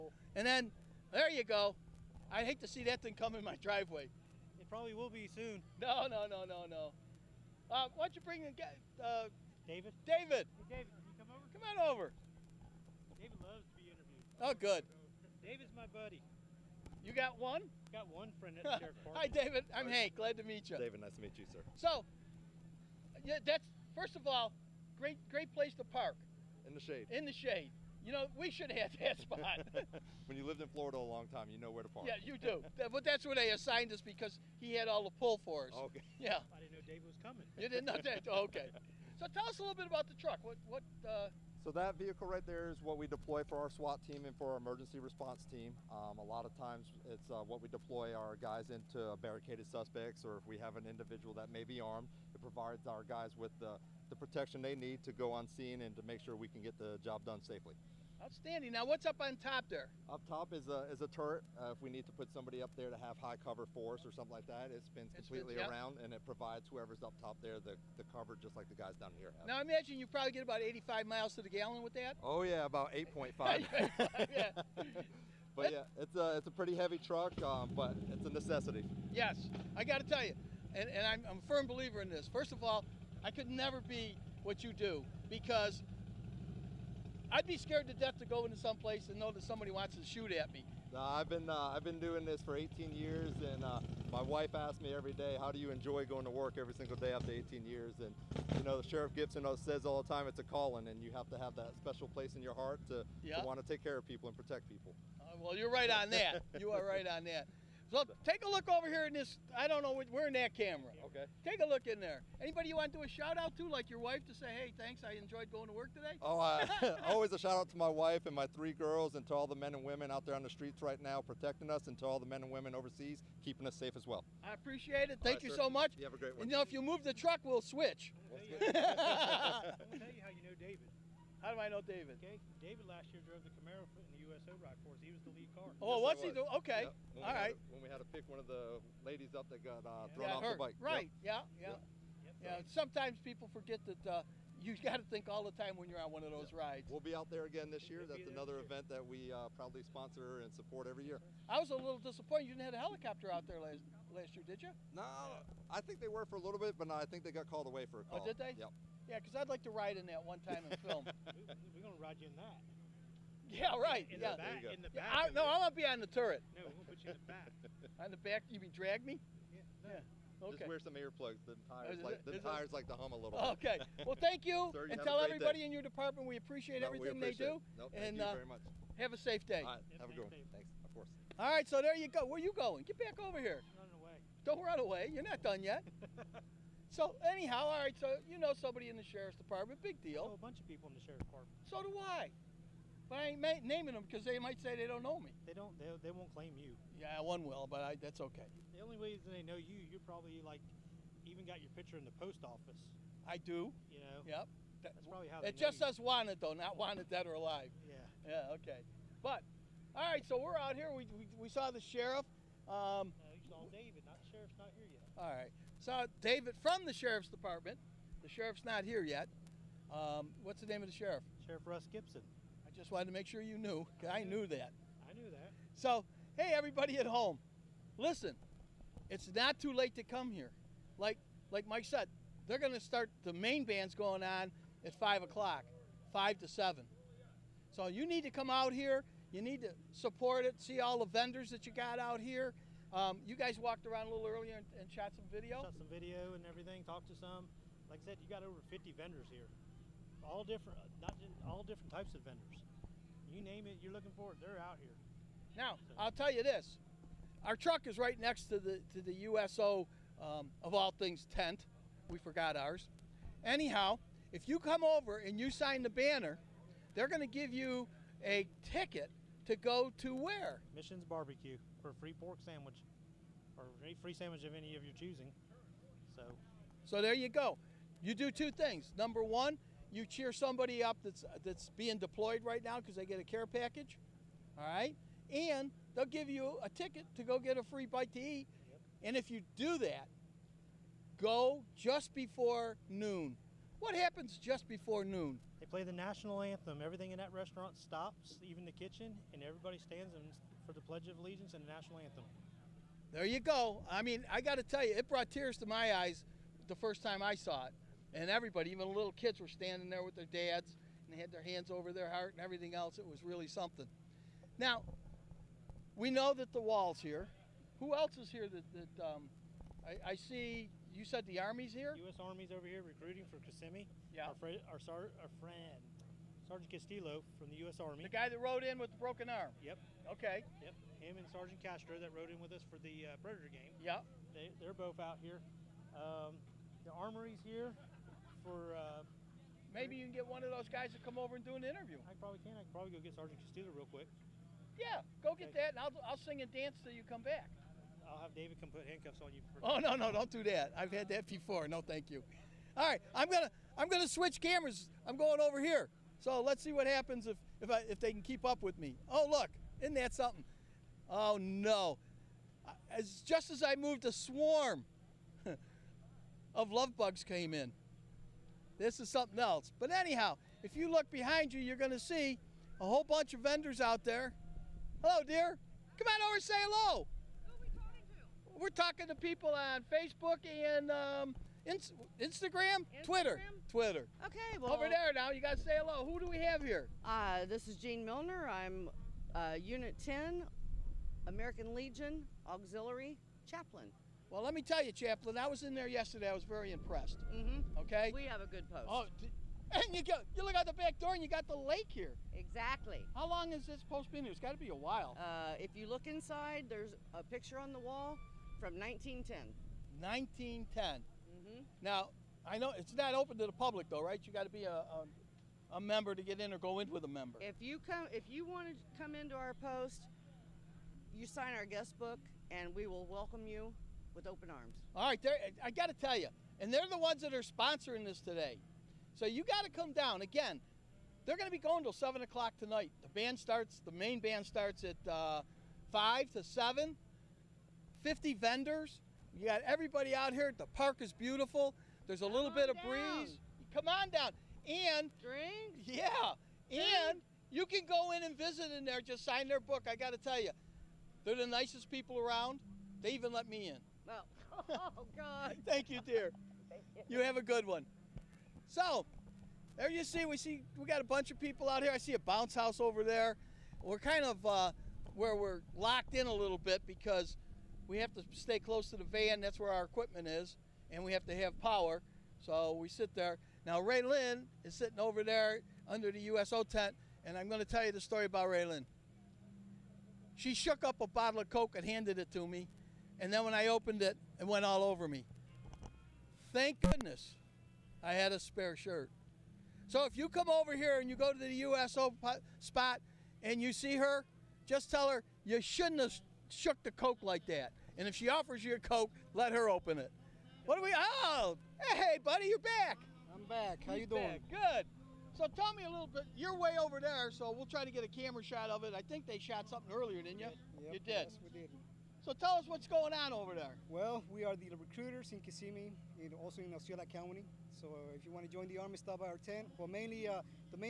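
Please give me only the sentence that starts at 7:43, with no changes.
We're kind of uh, where we're locked in a little bit because we have to stay close to the van.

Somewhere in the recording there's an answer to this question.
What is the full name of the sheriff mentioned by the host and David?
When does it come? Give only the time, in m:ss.
3:41.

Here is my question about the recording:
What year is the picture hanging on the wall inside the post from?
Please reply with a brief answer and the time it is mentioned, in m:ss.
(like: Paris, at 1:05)
1910, at 6:48.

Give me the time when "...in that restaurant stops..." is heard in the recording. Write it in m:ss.
4:57.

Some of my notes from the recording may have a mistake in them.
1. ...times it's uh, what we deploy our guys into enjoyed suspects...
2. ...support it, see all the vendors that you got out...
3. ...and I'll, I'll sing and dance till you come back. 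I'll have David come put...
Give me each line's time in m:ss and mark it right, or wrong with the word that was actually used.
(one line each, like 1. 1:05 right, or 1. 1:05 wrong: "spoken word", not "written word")
1. 0:46 wrong: "barricaded", not "enjoyed"
2. 3:59 right
3. 5:45 right.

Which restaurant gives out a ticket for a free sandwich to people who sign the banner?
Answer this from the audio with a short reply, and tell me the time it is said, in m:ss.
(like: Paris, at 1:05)
Missions Barbecue, at 4:30.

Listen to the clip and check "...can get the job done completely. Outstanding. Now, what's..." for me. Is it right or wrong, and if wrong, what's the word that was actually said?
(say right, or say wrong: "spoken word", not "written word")
wrong: "safely", not "completely".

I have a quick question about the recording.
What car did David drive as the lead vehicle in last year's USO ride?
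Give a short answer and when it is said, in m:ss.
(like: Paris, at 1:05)
Camaro, at 2:13.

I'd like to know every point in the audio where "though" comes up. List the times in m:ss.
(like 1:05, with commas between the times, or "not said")
3:26, 6:53.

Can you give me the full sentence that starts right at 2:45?
Yeah, I, no, I'm gonna be on the turret.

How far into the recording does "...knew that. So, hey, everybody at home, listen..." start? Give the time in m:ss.
3:45.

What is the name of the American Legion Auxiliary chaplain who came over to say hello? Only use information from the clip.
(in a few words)
Gene Milner.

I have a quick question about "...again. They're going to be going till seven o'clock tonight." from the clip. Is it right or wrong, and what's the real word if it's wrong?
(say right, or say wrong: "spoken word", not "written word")
right.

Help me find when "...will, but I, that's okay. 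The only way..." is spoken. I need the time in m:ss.
3:17.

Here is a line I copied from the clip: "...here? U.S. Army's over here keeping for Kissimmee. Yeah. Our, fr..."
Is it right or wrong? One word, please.
wrong.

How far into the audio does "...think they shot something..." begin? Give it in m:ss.
8:29.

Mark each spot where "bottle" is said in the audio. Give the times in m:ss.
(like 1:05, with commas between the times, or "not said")
8:01.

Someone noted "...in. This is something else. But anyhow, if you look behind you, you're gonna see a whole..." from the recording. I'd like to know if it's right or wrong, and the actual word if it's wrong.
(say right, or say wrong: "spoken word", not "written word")
right.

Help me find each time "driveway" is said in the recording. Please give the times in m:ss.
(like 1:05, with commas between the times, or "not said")
0:03.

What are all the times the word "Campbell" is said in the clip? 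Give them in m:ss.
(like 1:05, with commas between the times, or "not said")
not said.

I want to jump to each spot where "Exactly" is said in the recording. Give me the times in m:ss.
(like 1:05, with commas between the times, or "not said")
6:42.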